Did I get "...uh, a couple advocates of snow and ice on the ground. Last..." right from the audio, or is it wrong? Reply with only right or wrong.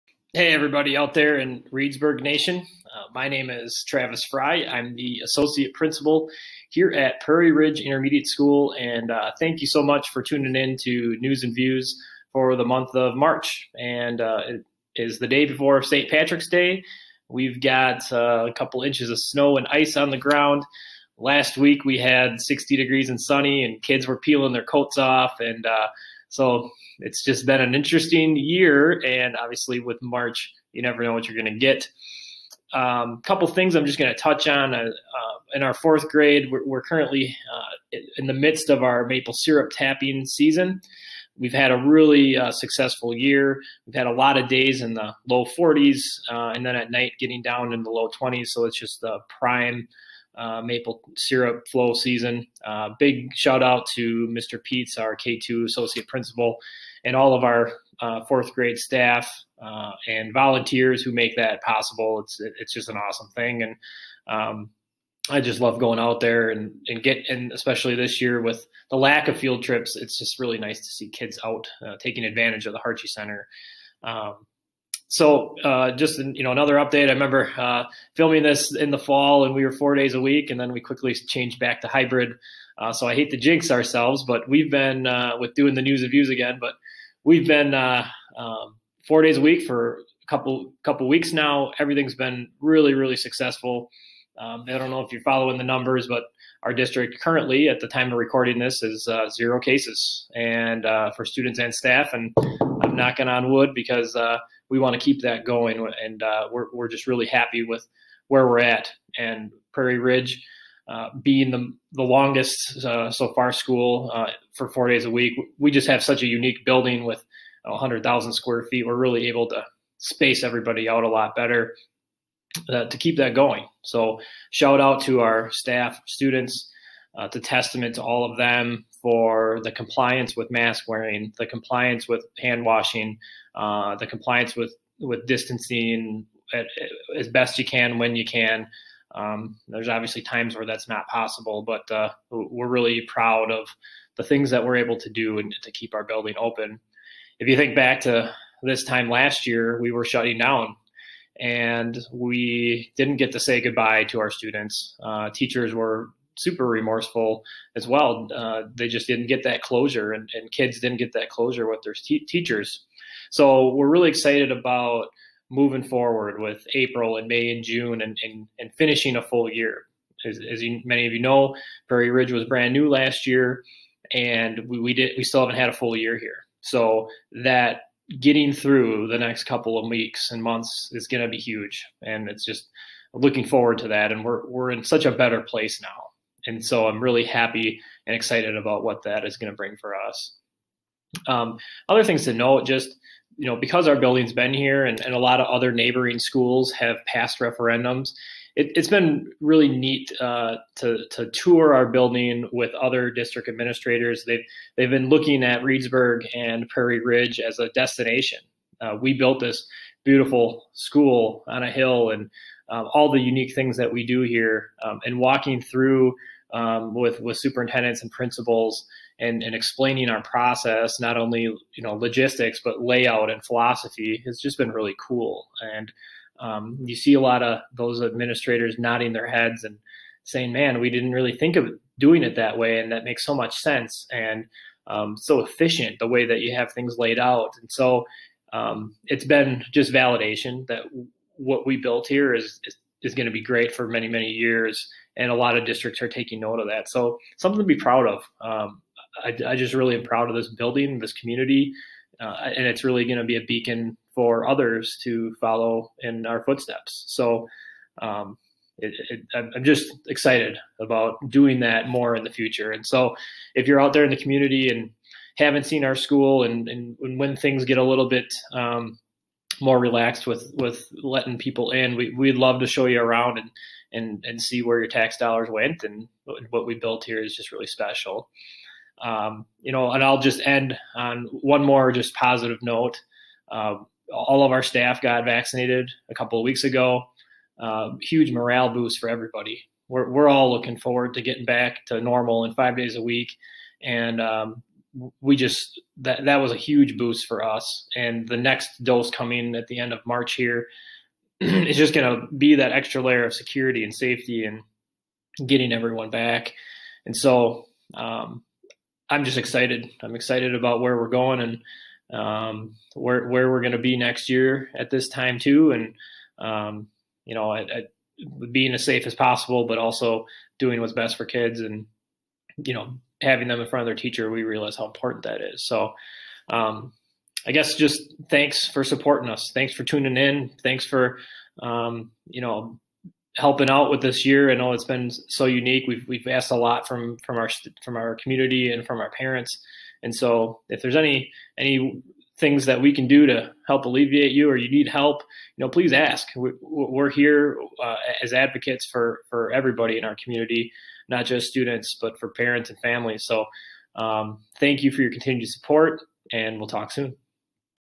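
wrong.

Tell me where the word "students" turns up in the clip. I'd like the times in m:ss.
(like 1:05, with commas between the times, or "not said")
1:41, 2:06, 2:34, 5:51.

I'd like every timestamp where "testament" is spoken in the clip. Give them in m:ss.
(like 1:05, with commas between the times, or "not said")
2:07.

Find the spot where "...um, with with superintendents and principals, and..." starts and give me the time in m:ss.
3:36.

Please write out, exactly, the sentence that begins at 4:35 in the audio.
And what we built here is just really special.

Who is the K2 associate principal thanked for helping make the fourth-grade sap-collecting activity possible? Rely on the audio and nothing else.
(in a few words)
Mr. Peets.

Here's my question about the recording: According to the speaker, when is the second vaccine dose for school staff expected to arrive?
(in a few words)
End of March.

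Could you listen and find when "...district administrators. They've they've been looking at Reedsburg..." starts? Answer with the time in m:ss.
3:23.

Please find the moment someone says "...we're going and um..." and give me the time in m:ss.
5:10.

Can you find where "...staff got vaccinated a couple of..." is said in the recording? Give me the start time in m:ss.
4:44.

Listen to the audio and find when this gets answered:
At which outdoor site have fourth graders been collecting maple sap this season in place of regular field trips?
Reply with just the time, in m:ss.
1:12.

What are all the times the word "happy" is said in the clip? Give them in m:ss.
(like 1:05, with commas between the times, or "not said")
1:47, 3:07.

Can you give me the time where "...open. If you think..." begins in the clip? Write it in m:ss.
2:26.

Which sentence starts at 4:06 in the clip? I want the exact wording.
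So something to be proud of.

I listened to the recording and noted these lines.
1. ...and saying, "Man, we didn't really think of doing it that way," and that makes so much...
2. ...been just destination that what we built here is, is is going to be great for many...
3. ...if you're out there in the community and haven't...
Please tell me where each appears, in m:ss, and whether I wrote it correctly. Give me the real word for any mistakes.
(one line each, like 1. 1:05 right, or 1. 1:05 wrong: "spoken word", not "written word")
1. 3:49 right
2. 3:59 wrong: "validation", not "destination"
3. 4:23 right.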